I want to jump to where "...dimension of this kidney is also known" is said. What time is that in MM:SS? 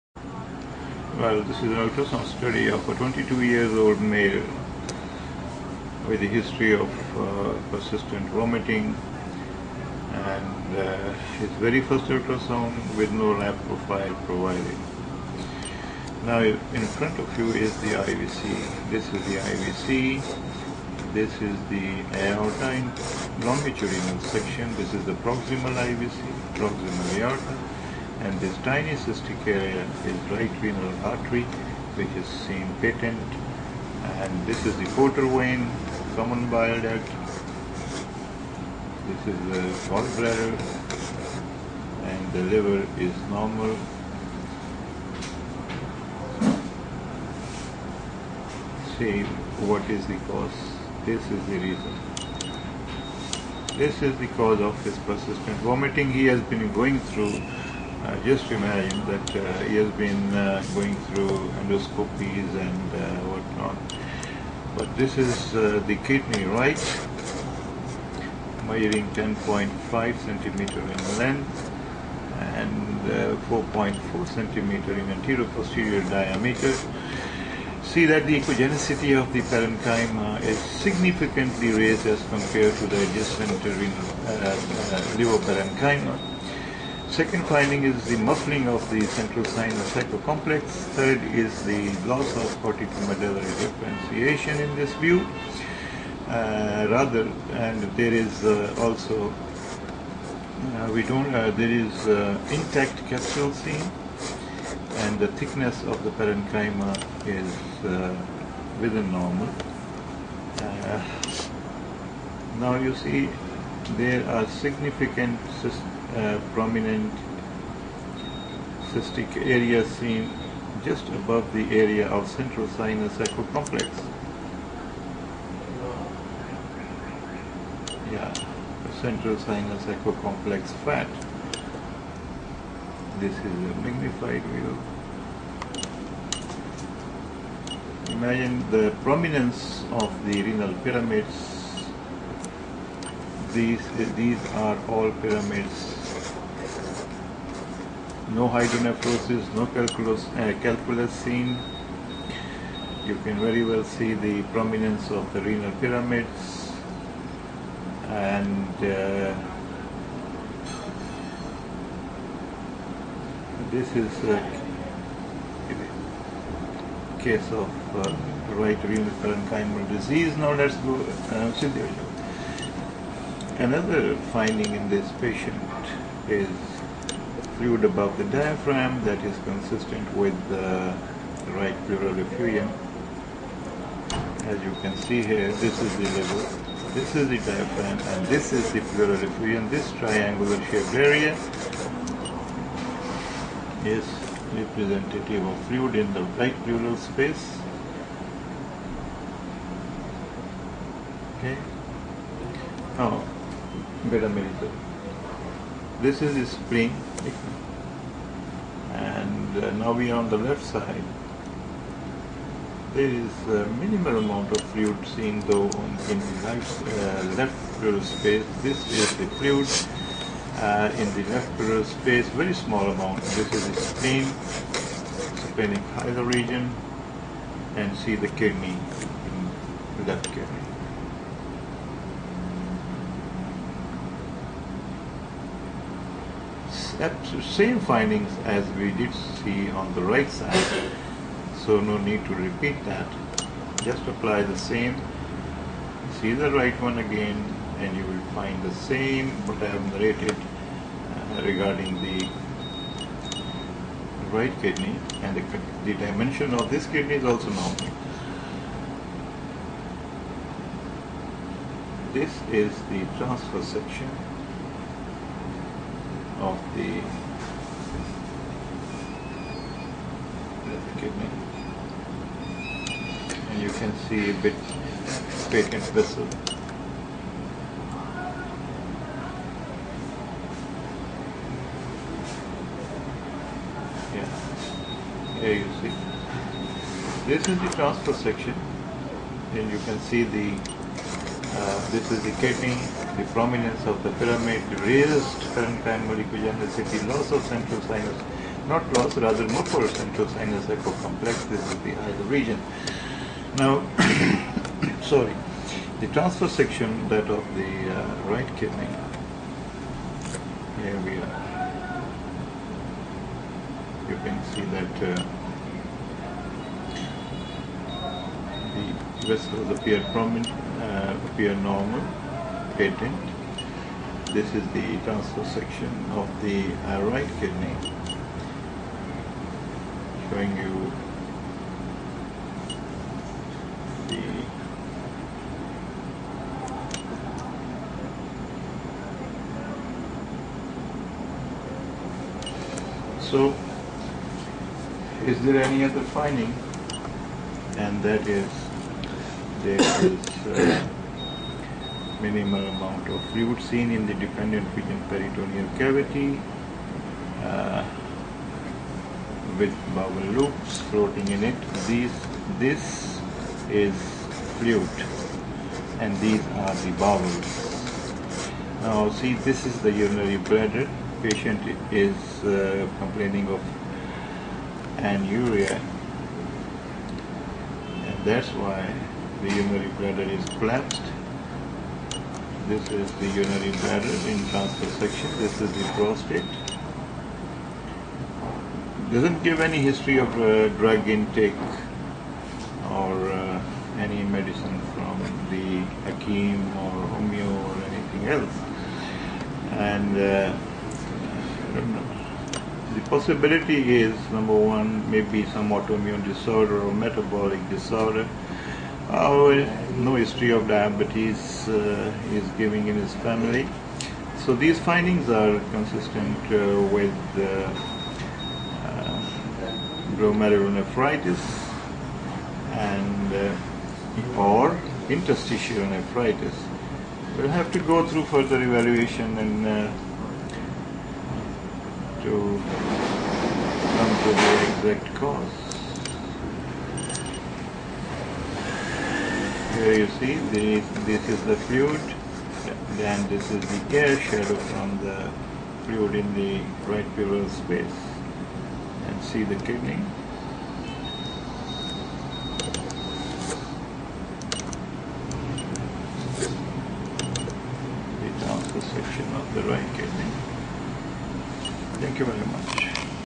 04:16.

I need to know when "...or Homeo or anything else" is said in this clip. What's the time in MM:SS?
06:36.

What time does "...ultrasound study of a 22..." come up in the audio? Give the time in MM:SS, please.
00:01.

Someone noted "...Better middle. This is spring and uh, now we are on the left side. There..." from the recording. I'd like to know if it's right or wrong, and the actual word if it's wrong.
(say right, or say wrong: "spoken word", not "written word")
right.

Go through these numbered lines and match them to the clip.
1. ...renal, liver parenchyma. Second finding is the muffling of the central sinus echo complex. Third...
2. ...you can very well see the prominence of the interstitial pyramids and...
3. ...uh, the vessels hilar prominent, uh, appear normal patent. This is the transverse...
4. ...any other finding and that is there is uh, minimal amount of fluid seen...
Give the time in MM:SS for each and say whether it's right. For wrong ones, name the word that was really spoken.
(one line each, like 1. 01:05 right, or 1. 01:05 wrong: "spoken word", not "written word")
1. 01:23 right
2. 02:33 wrong: "renal", not "interstitial"
3. 05:15 wrong: "appear", not "hilar"
4. 05:45 right.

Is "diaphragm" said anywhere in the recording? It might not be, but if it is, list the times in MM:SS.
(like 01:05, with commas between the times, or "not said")
02:58, 03:07.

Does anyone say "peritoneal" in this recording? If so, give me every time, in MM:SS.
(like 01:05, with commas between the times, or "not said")
05:55.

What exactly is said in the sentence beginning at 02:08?
Yeah, central sinus echo complex fat.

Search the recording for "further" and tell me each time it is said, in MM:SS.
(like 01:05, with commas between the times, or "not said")
07:08.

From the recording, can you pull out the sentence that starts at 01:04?
But this is uh, the kidney, right?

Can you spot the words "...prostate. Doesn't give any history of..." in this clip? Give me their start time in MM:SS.
06:25.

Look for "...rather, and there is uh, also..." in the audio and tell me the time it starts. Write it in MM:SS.
01:36.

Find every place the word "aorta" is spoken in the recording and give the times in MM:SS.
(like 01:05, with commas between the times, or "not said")
00:22, 00:27.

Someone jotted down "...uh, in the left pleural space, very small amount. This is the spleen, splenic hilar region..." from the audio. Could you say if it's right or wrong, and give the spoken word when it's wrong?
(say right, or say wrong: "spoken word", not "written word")
right.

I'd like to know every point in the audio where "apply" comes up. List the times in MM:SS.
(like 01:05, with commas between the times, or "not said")
04:04.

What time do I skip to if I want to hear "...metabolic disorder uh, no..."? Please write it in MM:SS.
06:46.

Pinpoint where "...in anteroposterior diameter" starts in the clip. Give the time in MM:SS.
01:14.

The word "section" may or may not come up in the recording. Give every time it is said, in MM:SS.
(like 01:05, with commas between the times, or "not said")
00:24, 04:23, 04:48, 05:06, 05:25, 06:24.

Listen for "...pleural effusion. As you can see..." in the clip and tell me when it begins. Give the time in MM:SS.
03:01.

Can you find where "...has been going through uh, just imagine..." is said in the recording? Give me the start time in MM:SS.
00:56.